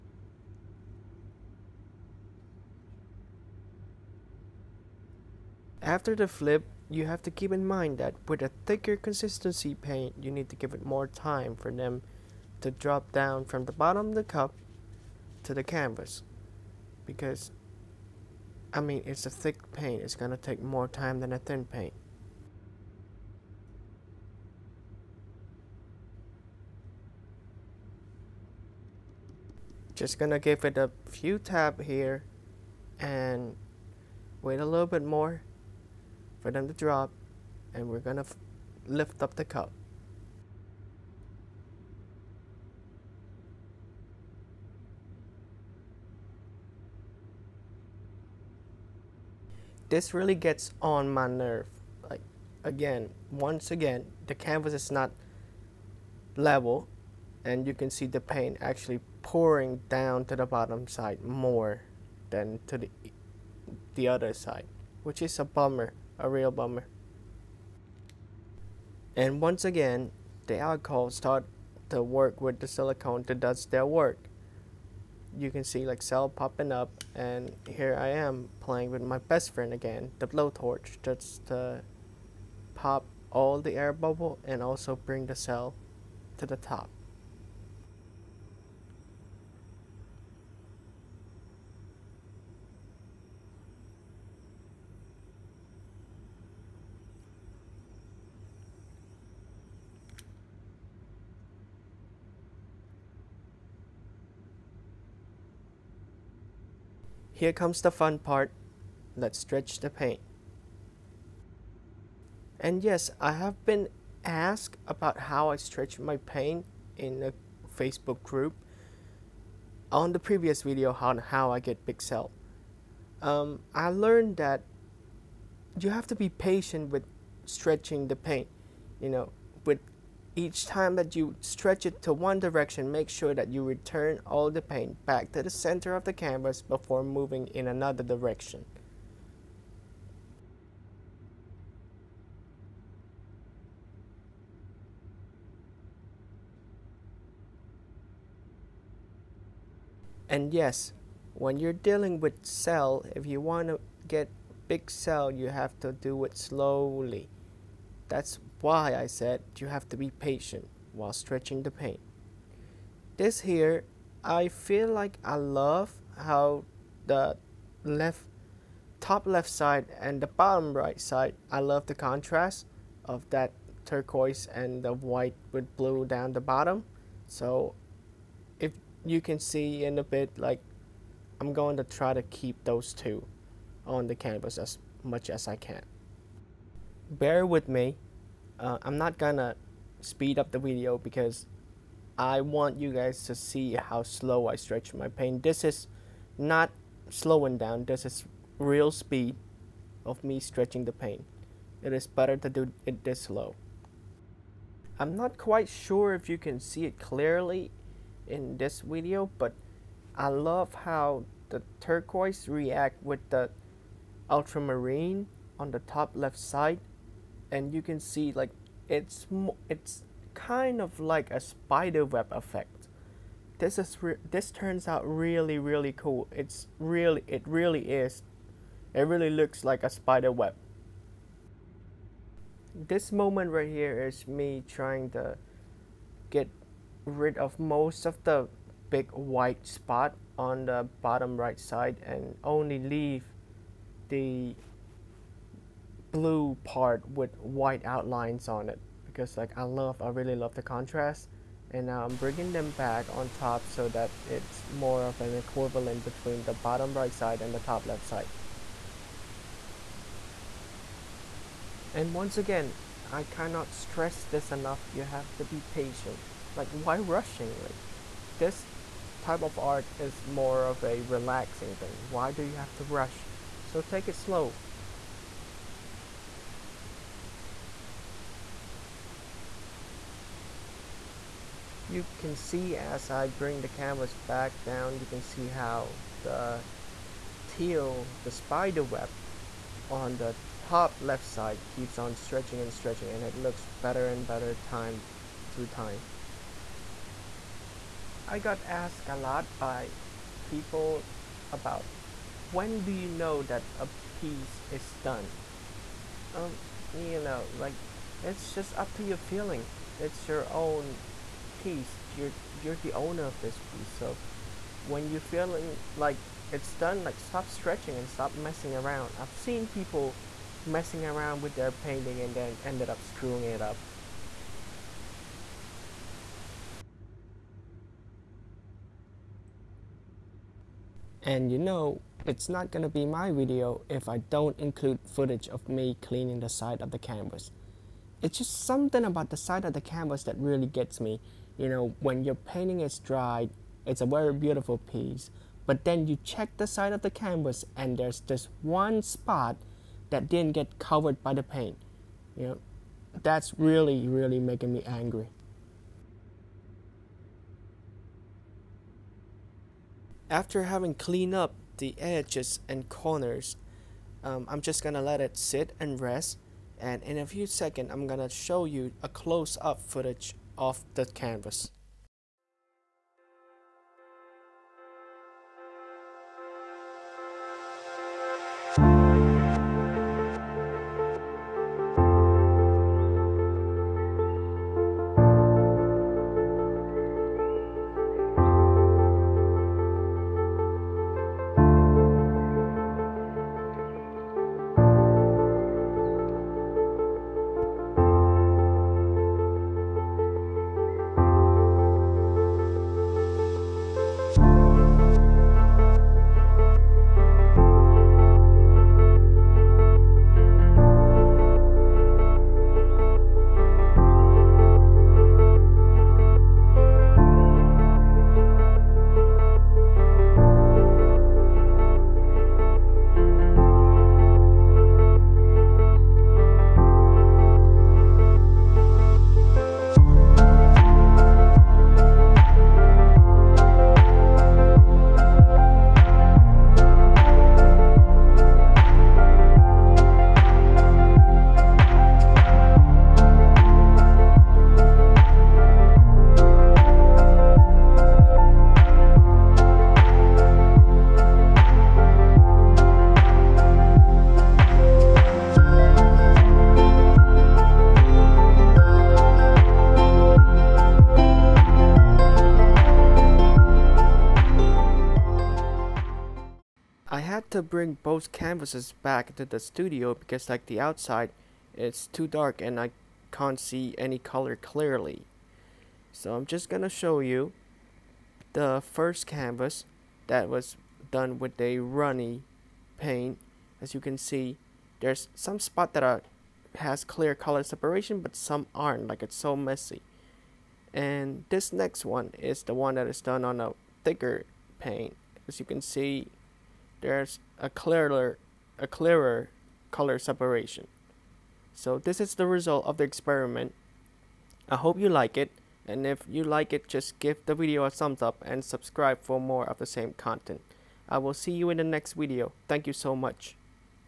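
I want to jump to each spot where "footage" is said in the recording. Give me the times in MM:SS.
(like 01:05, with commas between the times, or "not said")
05:35, 06:09.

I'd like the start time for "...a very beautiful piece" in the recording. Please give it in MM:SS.
05:43.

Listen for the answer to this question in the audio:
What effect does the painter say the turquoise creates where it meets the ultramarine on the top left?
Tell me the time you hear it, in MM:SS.
03:41.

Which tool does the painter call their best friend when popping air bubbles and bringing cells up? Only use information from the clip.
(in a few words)
The blowtorch.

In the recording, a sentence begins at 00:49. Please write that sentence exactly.
This really gets on my nerve.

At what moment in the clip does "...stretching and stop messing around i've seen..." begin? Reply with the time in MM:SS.
05:17.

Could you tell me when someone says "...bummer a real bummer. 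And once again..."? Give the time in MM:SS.
01:05.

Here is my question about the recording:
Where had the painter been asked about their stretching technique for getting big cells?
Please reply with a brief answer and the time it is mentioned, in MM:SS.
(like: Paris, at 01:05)
A Facebook group, at 01:57.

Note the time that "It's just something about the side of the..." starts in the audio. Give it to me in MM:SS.
05:38.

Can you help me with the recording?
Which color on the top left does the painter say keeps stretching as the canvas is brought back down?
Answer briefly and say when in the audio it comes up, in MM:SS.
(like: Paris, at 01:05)
Teal, at 04:47.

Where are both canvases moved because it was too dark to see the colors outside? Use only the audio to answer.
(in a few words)
The studio.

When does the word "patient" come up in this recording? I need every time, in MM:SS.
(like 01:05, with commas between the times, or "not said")
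02:06, 02:40, 04:25.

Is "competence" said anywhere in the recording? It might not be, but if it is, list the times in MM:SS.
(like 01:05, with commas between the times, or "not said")
not said.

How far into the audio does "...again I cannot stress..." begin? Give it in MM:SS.
04:22.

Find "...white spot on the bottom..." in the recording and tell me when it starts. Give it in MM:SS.
03:59.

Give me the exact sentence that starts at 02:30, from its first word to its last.
And yes, when you're dealing with cell, if you want to get big cell, you have to do it slowly.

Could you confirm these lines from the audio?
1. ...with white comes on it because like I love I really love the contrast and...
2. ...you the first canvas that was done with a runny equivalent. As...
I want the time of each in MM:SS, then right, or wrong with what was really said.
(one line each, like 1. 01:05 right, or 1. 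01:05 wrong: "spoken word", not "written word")
1. 04:07 wrong: "outlines", not "comes"
2. 07:57 wrong: "paint", not "equivalent".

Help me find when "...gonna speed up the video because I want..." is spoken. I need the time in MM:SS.
03:09.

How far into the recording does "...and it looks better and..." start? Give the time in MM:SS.
04:53.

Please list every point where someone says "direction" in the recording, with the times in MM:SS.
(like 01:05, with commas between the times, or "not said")
02:12, 02:18.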